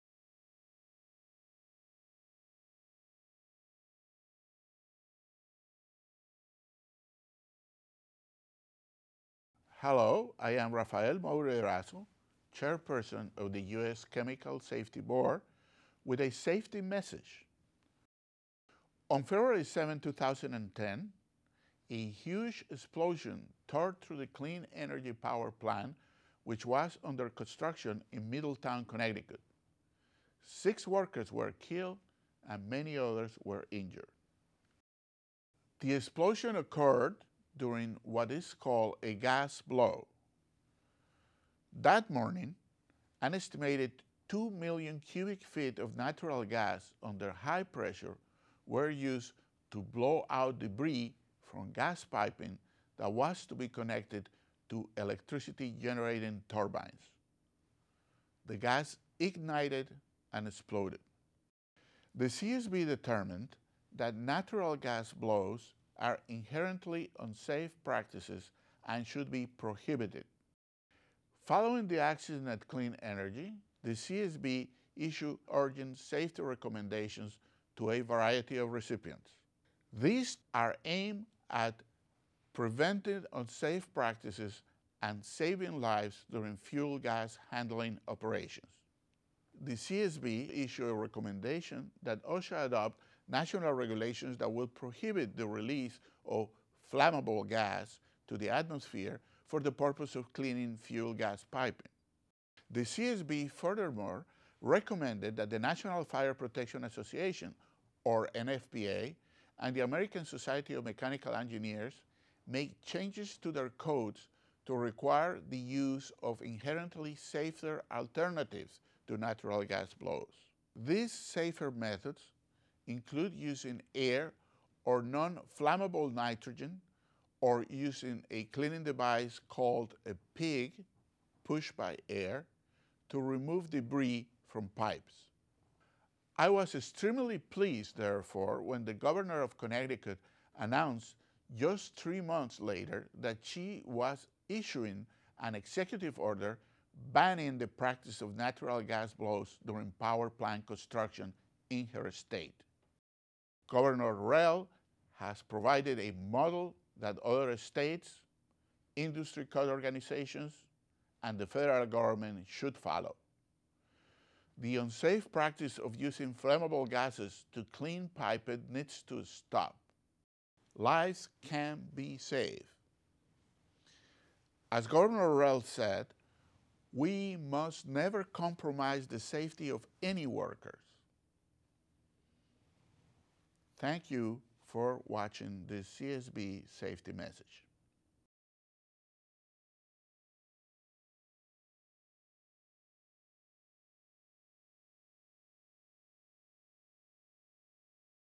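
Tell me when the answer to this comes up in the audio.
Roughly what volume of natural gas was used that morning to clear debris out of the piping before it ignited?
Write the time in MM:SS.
00:44.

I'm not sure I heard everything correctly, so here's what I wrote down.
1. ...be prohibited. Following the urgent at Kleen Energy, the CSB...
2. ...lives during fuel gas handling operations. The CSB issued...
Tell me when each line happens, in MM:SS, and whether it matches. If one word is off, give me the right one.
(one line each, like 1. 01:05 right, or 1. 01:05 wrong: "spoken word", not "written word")
1. 01:09 wrong: "accident", not "urgent"
2. 01:25 right.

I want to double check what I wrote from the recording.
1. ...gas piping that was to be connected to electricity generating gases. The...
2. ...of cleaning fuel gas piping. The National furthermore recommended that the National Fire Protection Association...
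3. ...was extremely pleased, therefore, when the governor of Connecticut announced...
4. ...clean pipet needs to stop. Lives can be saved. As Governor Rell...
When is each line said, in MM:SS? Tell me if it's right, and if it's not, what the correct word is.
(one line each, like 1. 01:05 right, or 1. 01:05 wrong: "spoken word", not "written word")
1. 00:51 wrong: "turbines", not "gases"
2. 01:40 wrong: "CSB", not "National"
3. 02:16 right
4. 02:47 right.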